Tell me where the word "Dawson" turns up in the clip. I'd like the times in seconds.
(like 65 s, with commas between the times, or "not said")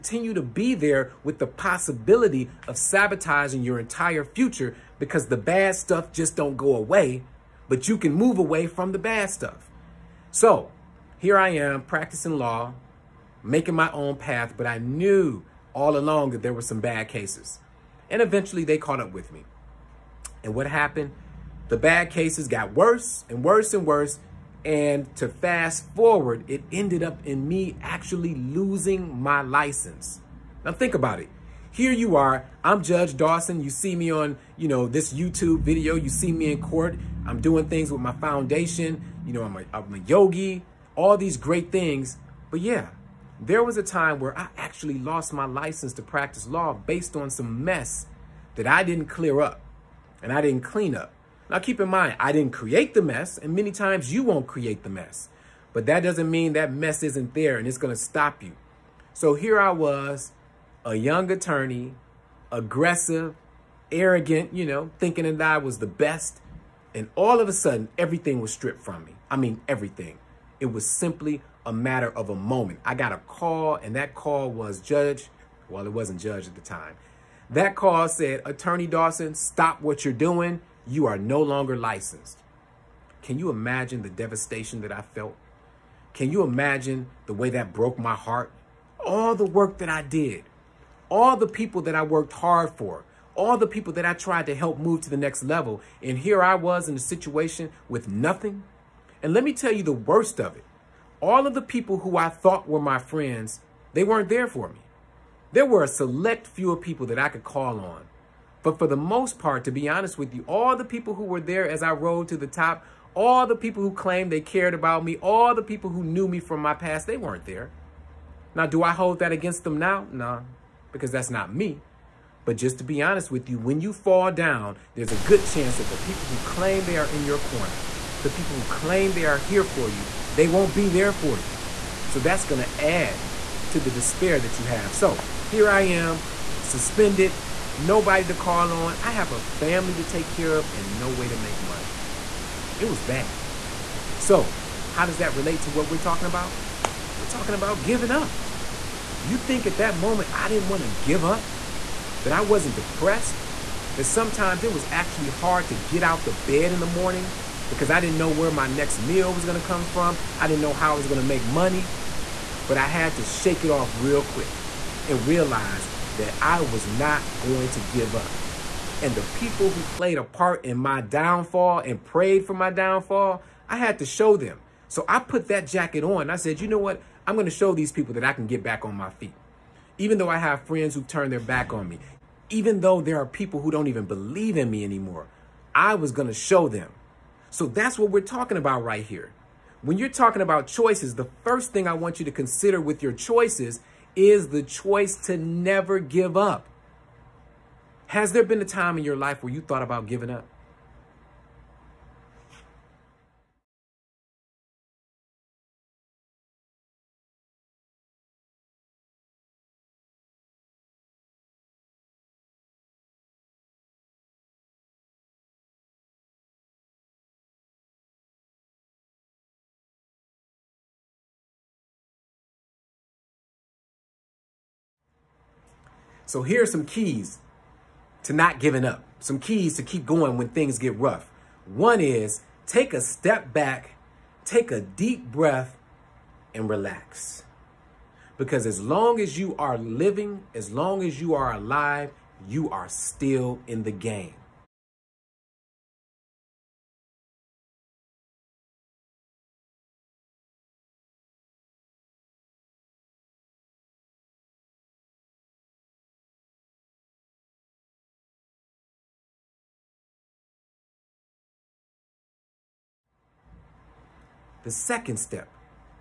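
33 s, 78 s.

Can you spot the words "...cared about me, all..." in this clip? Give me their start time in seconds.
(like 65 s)
114 s.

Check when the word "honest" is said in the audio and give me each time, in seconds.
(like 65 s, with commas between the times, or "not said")
109 s, 123 s.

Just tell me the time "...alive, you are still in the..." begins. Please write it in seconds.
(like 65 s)
241 s.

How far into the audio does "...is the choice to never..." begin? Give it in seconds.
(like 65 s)
194 s.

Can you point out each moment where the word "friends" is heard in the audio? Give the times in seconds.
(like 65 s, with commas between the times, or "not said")
102 s, 180 s.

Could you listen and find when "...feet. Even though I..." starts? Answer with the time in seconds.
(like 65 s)
179 s.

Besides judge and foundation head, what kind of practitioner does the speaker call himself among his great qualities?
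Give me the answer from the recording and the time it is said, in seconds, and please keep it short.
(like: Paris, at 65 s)
Yogi, at 39 s.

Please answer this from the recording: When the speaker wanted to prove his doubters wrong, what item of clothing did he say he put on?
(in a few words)
Jacket.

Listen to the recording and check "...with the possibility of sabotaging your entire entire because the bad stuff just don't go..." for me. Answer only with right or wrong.
wrong.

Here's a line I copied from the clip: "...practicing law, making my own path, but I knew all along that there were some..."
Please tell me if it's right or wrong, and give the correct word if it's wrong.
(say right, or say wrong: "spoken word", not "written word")
right.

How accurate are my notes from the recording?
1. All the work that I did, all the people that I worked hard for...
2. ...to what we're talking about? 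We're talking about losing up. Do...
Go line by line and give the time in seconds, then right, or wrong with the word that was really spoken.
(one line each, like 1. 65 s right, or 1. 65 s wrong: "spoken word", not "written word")
1. 89 s right
2. 145 s wrong: "giving", not "losing".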